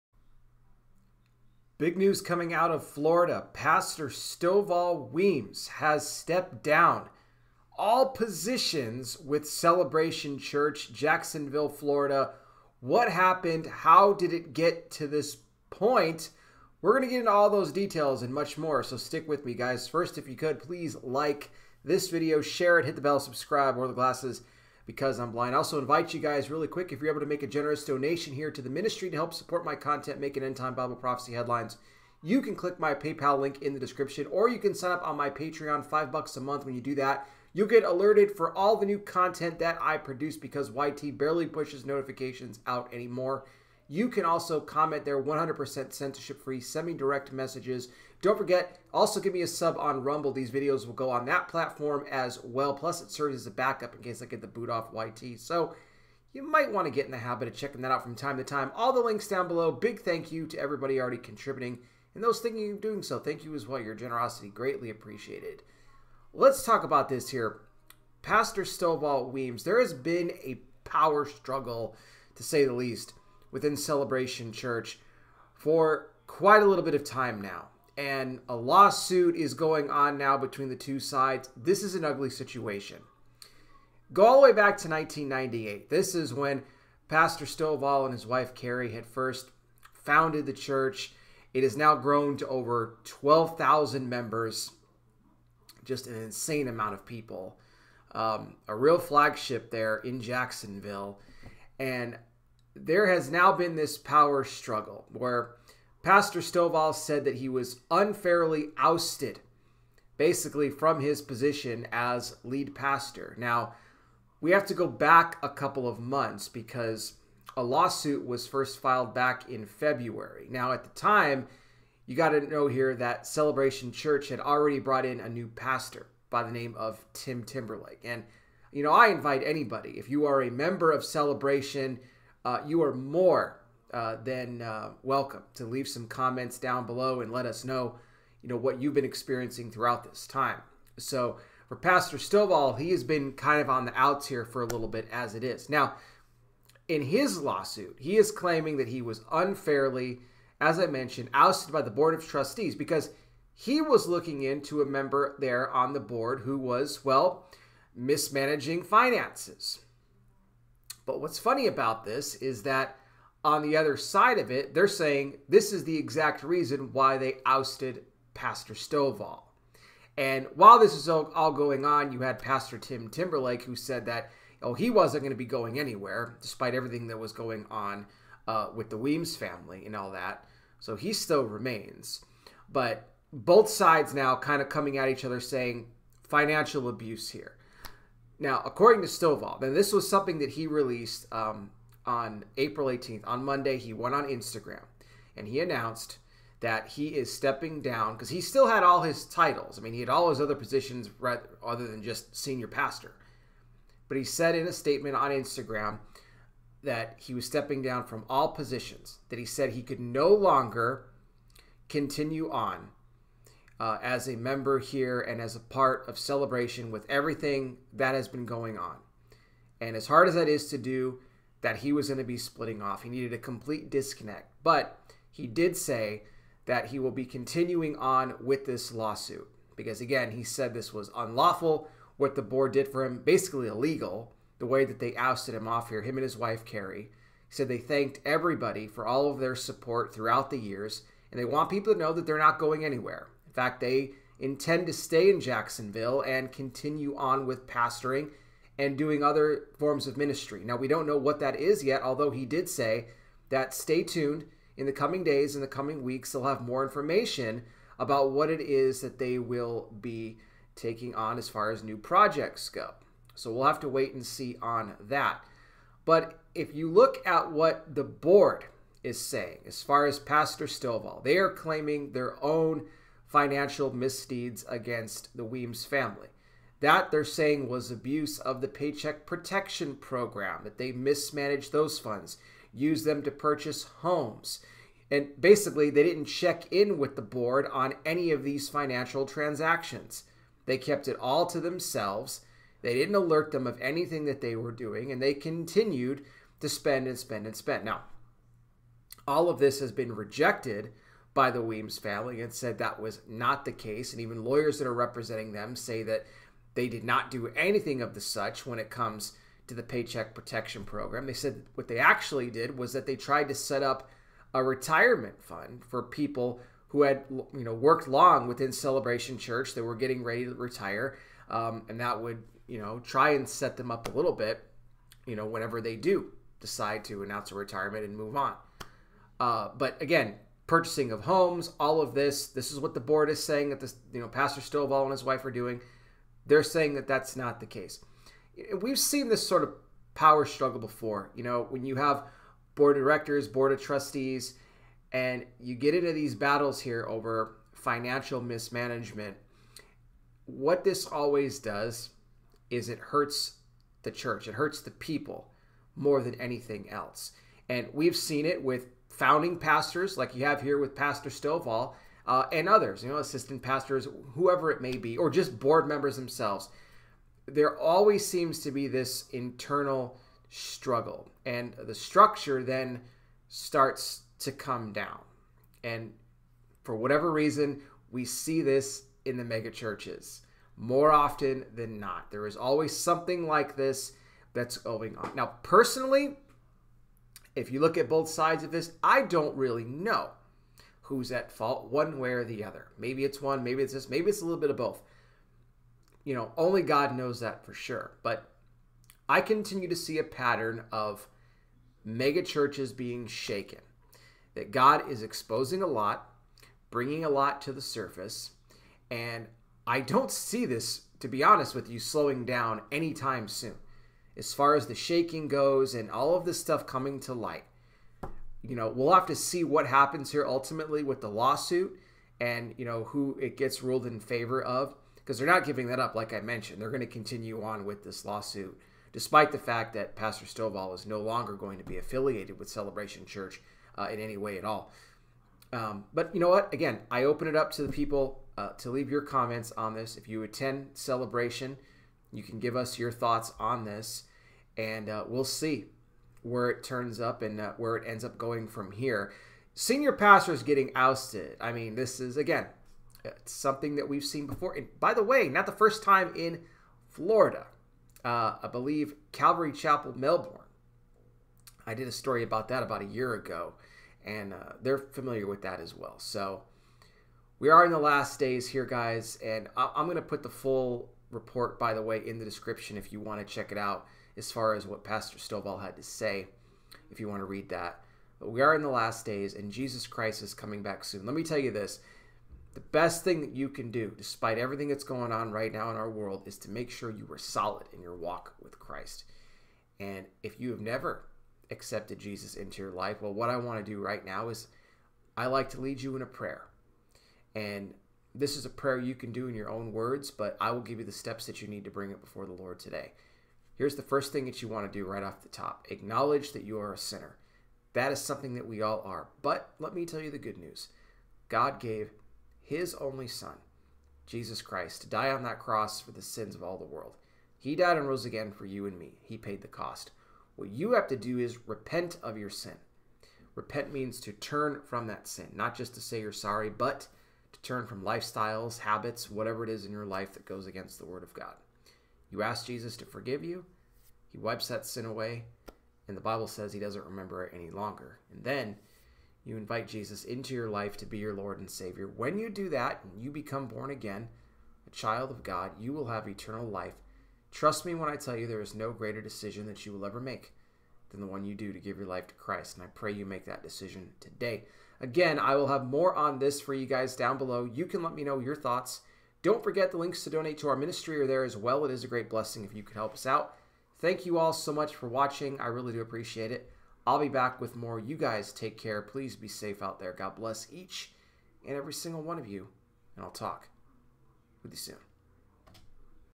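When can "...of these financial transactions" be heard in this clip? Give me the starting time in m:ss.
4:48.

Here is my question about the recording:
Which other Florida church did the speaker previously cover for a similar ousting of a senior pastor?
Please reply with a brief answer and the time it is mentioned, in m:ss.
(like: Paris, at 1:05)
Calvary Chapel, Melbourne, at 7:39.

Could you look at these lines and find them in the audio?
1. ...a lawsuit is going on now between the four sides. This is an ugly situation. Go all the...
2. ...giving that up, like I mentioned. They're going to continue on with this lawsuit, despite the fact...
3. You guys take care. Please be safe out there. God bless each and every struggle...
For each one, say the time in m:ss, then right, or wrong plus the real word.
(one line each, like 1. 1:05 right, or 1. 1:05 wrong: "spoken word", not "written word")
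1. 1:18 wrong: "two", not "four"
2. 7:05 right
3. 9:27 wrong: "single", not "struggle".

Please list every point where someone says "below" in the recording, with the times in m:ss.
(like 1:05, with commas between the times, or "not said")
0:59, 2:16, 9:17.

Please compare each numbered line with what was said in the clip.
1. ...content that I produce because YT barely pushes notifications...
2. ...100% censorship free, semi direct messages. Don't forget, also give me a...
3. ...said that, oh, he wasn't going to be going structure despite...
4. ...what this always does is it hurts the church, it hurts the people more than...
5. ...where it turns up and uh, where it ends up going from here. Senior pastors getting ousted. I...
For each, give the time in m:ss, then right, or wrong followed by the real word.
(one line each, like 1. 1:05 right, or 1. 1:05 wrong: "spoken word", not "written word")
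1. 0:38 right
2. 0:45 right
3. 2:53 wrong: "anywhere", not "structure"
4. 5:50 right
5. 7:26 right.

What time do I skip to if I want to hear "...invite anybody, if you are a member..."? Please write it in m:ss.
2:09.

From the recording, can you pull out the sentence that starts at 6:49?
And I don't see this, to be honest with you, slowing down anytime soon.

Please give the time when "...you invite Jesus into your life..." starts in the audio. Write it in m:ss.
8:59.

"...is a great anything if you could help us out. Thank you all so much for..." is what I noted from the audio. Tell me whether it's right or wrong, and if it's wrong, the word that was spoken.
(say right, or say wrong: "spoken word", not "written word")
wrong: "blessing", not "anything".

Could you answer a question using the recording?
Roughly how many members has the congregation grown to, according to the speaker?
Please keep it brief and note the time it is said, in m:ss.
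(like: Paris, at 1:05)
12,000, at 1:33.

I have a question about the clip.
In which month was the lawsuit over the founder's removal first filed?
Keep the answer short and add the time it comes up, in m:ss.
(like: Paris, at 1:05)
February, at 1:59.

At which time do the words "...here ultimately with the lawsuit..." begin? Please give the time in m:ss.
7:00.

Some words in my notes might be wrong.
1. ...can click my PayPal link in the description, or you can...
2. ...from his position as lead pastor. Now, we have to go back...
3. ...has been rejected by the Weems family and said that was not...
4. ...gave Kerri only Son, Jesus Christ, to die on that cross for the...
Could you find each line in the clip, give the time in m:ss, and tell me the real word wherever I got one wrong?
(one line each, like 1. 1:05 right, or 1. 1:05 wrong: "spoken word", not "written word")
1. 0:32 right
2. 1:50 right
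3. 4:59 right
4. 8:31 wrong: "His", not "Kerri".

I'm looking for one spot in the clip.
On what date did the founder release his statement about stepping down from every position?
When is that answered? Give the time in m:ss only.
3:12.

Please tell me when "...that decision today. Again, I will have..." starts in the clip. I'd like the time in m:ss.
9:13.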